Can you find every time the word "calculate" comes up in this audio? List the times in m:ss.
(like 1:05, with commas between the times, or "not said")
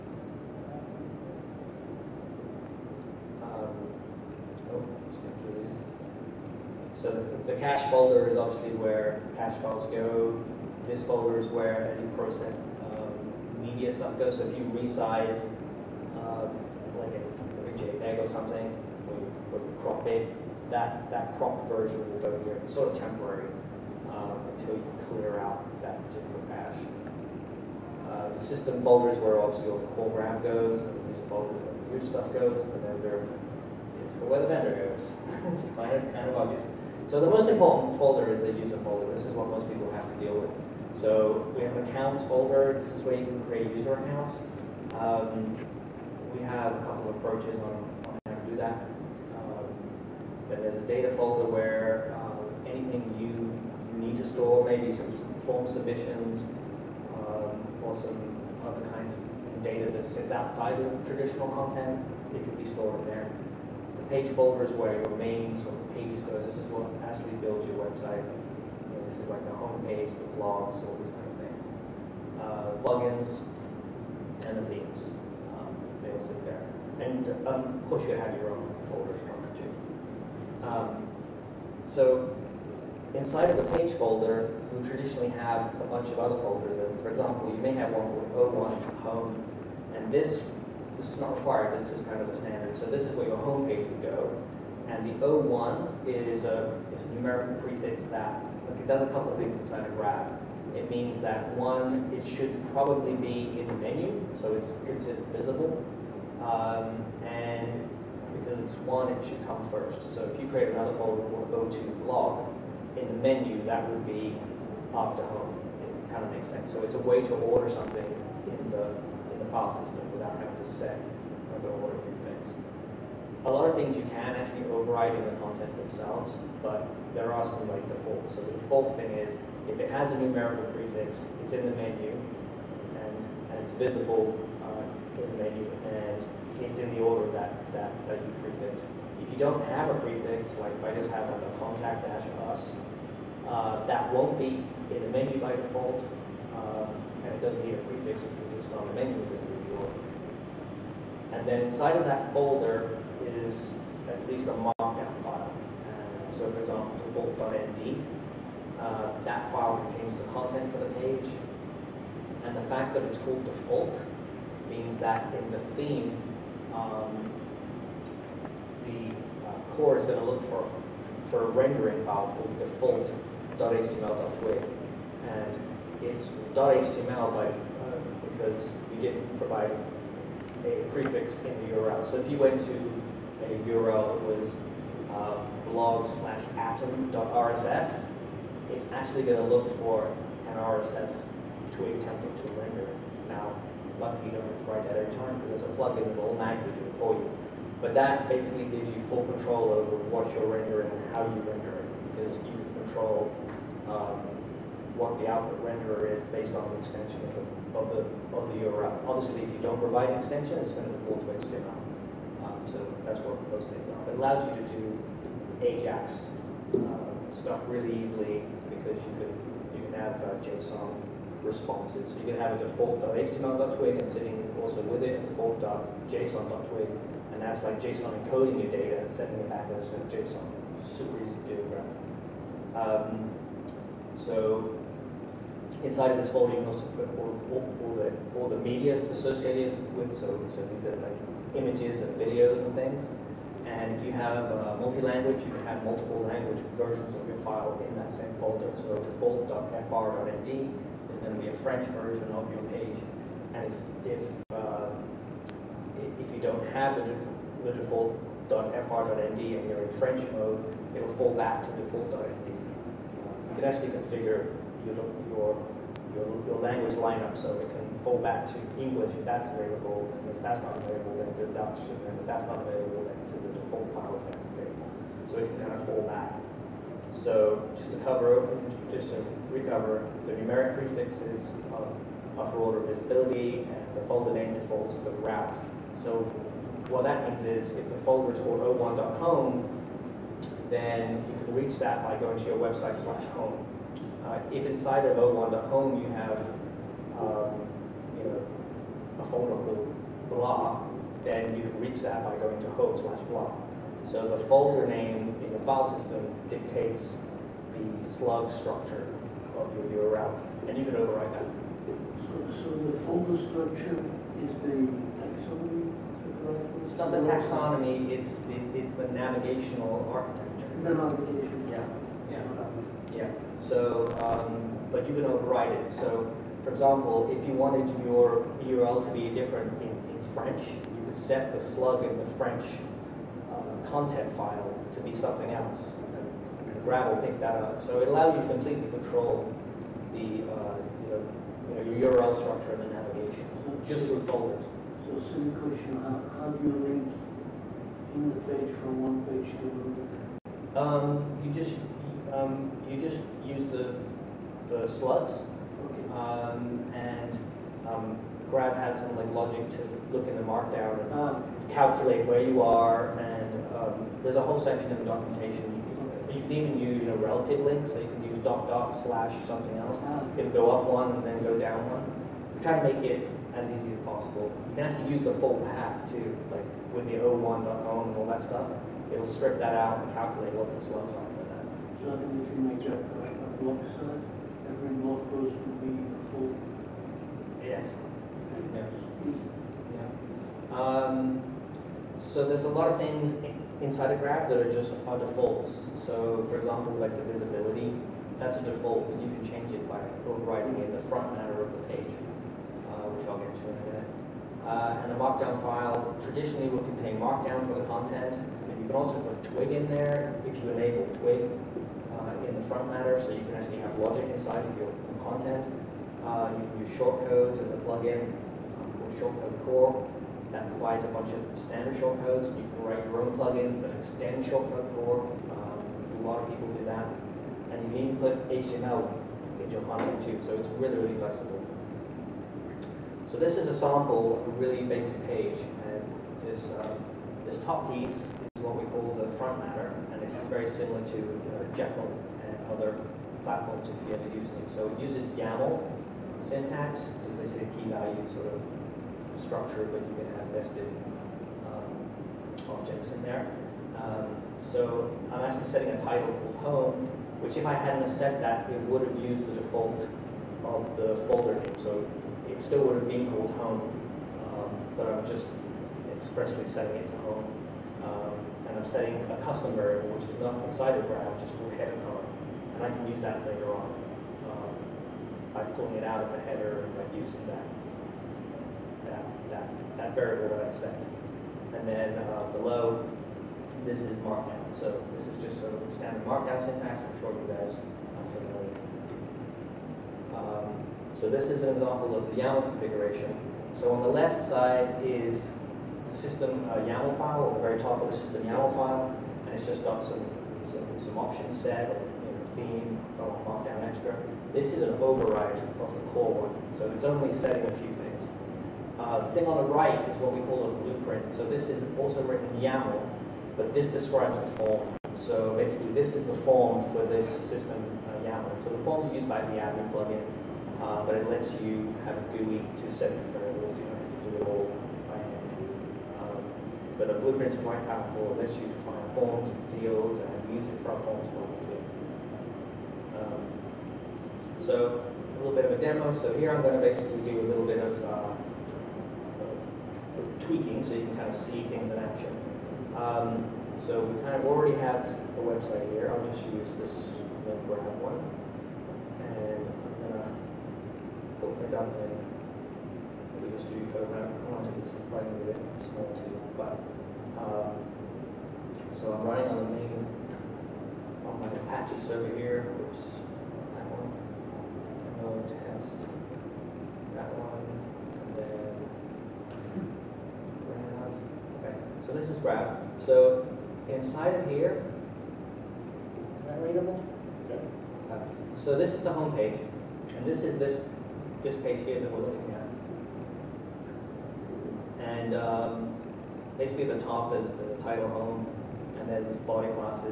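6:01, 6:20.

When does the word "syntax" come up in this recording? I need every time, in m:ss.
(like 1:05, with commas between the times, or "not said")
7:26, 8:06.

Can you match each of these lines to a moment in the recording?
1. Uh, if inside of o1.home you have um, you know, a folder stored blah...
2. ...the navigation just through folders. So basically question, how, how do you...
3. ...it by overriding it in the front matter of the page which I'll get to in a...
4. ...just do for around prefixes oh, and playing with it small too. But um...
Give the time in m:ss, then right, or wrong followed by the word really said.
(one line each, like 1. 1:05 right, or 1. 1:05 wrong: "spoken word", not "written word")
1. 4:54 wrong: "called", not "stored"
2. 5:42 wrong: "silly", not "basically"
3. 6:39 right
4. 9:13 wrong: "quantities", not "prefixes".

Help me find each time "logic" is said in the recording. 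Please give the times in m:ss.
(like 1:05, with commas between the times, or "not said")
5:59, 6:53.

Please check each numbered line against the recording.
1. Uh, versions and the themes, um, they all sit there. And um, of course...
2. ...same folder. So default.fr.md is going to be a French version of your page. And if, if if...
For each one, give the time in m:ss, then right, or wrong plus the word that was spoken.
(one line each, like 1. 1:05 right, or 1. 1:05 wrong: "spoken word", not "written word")
1. 1:12 wrong: "plugins", not "versions"
2. 4:08 right.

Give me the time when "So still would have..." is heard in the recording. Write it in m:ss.
7:41.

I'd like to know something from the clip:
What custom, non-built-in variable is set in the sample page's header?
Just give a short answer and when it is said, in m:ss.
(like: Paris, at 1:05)
header color, at 7:51.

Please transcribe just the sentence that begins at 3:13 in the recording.
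Now, lucky you don't have to write that every time because there's a plugin that will magically do it for you.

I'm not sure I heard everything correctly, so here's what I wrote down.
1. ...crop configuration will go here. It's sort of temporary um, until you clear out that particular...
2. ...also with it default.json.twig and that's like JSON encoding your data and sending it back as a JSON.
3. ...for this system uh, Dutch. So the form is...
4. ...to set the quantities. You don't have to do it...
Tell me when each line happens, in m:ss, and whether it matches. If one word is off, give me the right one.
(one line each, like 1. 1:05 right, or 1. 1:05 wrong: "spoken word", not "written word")
1. 0:21 wrong: "version", not "configuration"
2. 3:44 right
3. 8:36 wrong: "YAML", not "Dutch"
4. 8:42 wrong: "variables", not "quantities".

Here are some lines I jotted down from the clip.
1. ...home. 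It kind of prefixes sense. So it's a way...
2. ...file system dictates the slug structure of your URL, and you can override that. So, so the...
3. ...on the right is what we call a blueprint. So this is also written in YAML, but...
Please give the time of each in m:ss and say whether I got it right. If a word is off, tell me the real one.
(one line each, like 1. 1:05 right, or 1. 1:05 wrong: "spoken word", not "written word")
1. 1:55 wrong: "makes", not "prefixes"
2. 5:05 right
3. 8:29 right.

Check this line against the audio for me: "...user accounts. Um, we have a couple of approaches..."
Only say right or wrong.
right.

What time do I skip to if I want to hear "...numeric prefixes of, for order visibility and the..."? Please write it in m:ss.
4:40.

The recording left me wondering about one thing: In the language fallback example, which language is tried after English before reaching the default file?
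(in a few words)
Dutch.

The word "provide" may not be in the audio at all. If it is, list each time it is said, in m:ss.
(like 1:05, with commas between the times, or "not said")
2:59, 3:29, 7:00.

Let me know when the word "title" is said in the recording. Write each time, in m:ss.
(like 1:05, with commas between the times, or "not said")
7:35, 9:47.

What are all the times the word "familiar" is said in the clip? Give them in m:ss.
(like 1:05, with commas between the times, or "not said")
8:08.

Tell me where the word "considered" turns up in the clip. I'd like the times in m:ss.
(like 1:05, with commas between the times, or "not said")
1:44.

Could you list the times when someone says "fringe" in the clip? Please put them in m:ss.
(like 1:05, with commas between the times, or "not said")
not said.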